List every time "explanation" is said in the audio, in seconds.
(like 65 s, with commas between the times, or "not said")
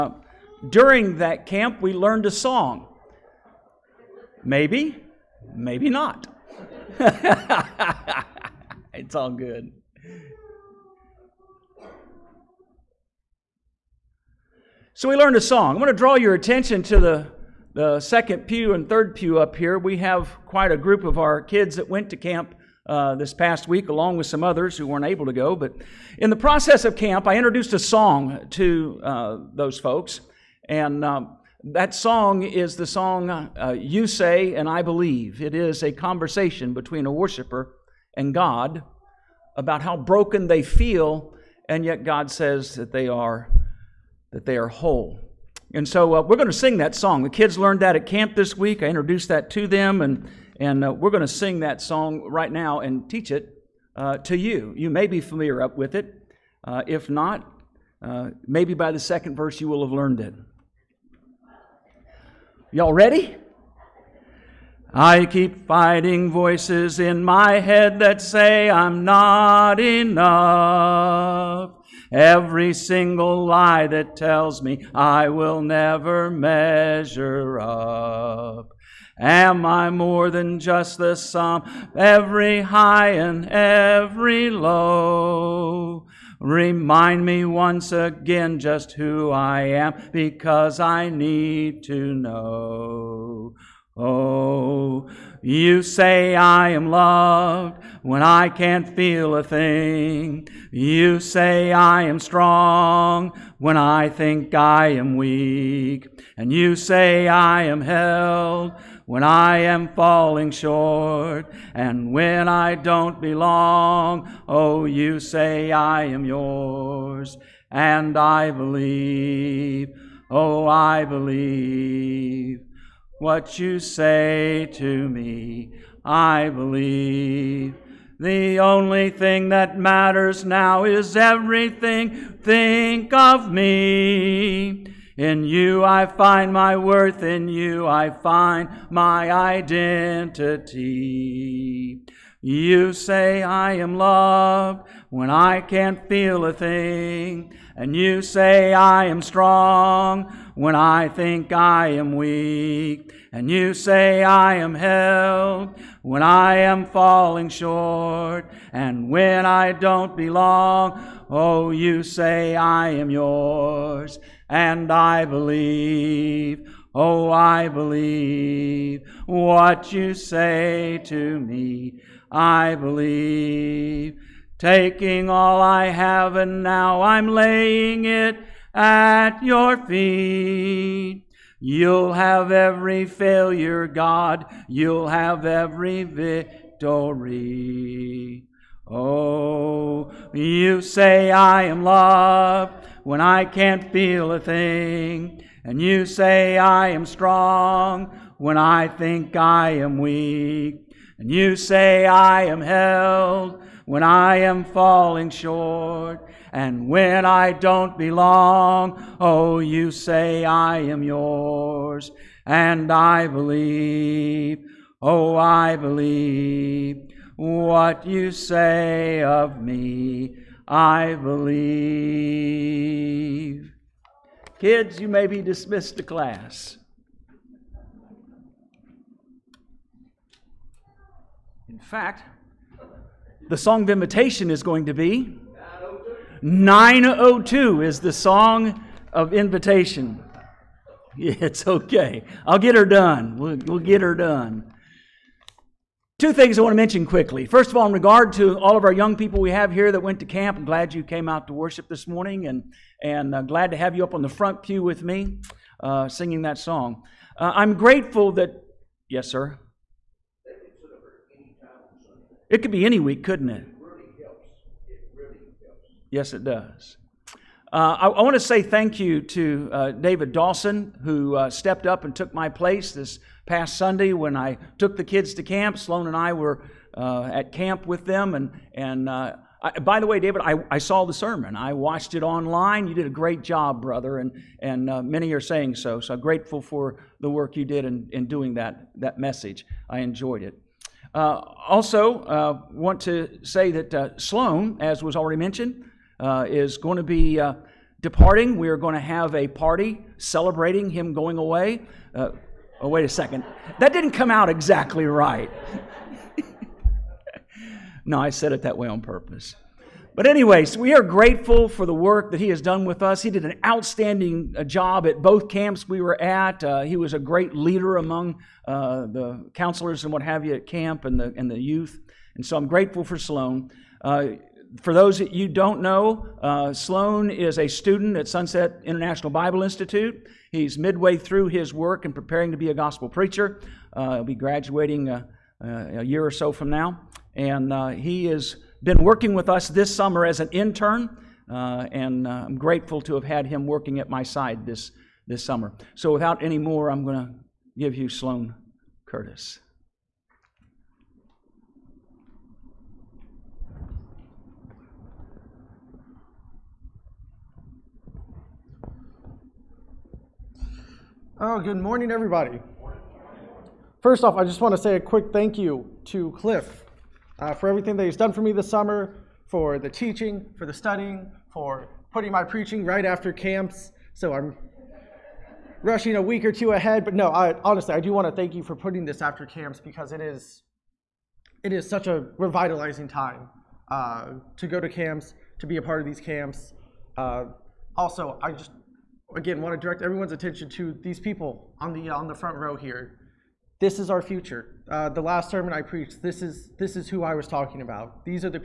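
not said.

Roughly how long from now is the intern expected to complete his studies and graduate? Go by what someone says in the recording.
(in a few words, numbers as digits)
a year or so.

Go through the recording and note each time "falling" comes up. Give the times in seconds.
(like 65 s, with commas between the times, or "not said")
109 s, 156 s, 204 s.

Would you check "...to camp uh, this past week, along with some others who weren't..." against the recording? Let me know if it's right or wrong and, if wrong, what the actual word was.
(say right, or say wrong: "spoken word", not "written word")
right.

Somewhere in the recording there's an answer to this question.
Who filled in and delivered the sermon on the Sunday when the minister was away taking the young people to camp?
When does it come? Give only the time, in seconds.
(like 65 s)
269 s.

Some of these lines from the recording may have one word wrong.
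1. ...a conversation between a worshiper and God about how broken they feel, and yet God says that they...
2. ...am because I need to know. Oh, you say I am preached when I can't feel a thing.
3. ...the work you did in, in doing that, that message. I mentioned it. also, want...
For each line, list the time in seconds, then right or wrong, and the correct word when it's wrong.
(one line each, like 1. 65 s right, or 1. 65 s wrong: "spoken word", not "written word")
1. 35 s right
2. 89 s wrong: "loved", not "preached"
3. 287 s wrong: "enjoyed", not "mentioned".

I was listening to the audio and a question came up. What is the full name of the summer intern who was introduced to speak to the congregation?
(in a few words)
Sloan Curtis.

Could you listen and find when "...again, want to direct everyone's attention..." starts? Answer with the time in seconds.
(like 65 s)
389 s.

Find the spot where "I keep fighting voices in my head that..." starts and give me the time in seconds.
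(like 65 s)
64 s.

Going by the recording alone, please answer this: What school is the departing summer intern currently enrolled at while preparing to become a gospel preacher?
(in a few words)
Sunset International Bible Institute.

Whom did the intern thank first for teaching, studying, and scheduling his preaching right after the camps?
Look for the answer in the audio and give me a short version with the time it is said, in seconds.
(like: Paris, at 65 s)
Cliff, at 366 s.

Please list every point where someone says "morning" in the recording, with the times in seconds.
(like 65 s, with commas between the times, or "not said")
252 s, 361 s.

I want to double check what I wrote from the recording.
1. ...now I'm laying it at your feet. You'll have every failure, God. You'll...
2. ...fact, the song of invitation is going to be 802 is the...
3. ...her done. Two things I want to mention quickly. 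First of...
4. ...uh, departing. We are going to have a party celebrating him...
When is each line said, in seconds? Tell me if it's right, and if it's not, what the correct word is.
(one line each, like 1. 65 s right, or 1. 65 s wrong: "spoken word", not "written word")
1. 176 s right
2. 231 s wrong: "902", not "802"
3. 243 s right
4. 297 s right.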